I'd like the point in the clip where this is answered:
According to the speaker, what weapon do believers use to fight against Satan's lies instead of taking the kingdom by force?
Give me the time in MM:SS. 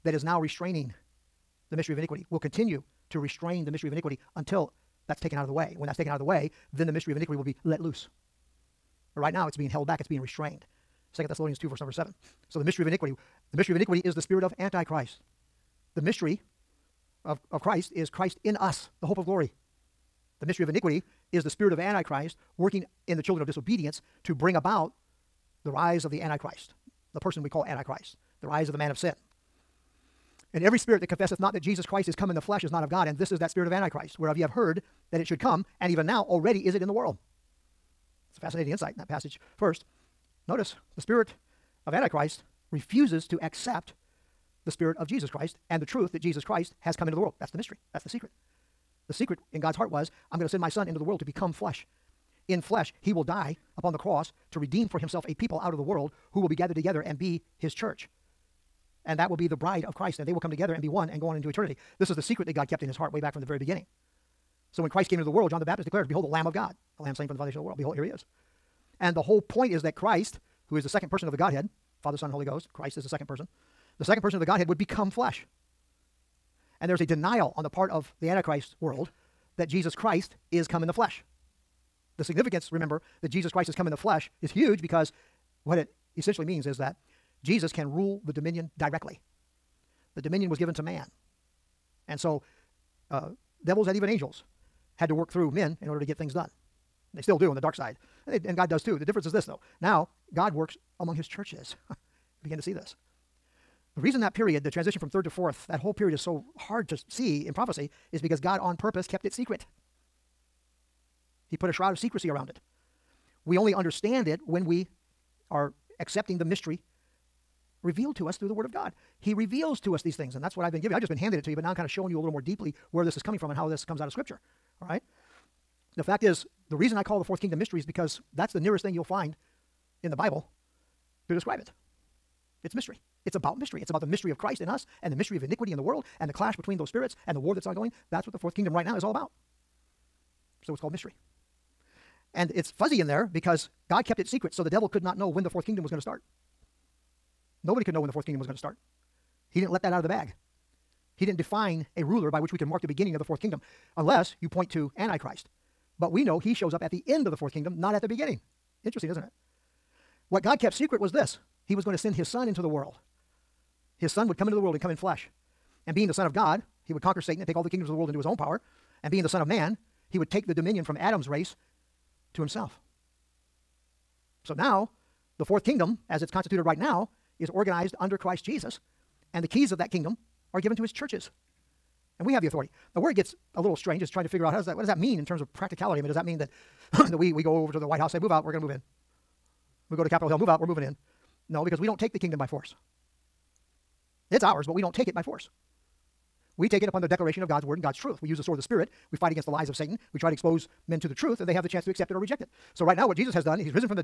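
03:18.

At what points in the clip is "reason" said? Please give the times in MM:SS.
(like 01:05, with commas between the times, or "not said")
01:44, 02:06.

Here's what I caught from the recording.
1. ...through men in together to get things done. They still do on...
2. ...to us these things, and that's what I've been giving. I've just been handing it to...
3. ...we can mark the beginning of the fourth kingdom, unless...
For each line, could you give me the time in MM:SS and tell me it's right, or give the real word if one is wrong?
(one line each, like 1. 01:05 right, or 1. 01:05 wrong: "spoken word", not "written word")
1. 01:35 wrong: "order", not "together"
2. 01:59 right
3. 02:32 right.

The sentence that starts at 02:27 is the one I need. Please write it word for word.
Nobody could know when the fourth kingdom was going to start.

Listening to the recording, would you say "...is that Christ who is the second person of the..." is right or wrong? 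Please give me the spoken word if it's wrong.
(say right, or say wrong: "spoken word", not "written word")
right.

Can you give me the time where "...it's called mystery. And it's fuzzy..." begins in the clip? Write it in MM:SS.
02:20.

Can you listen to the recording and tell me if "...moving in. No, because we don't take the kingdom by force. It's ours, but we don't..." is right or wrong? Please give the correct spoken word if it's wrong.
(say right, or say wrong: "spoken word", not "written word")
right.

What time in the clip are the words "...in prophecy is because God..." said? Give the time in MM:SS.
01:47.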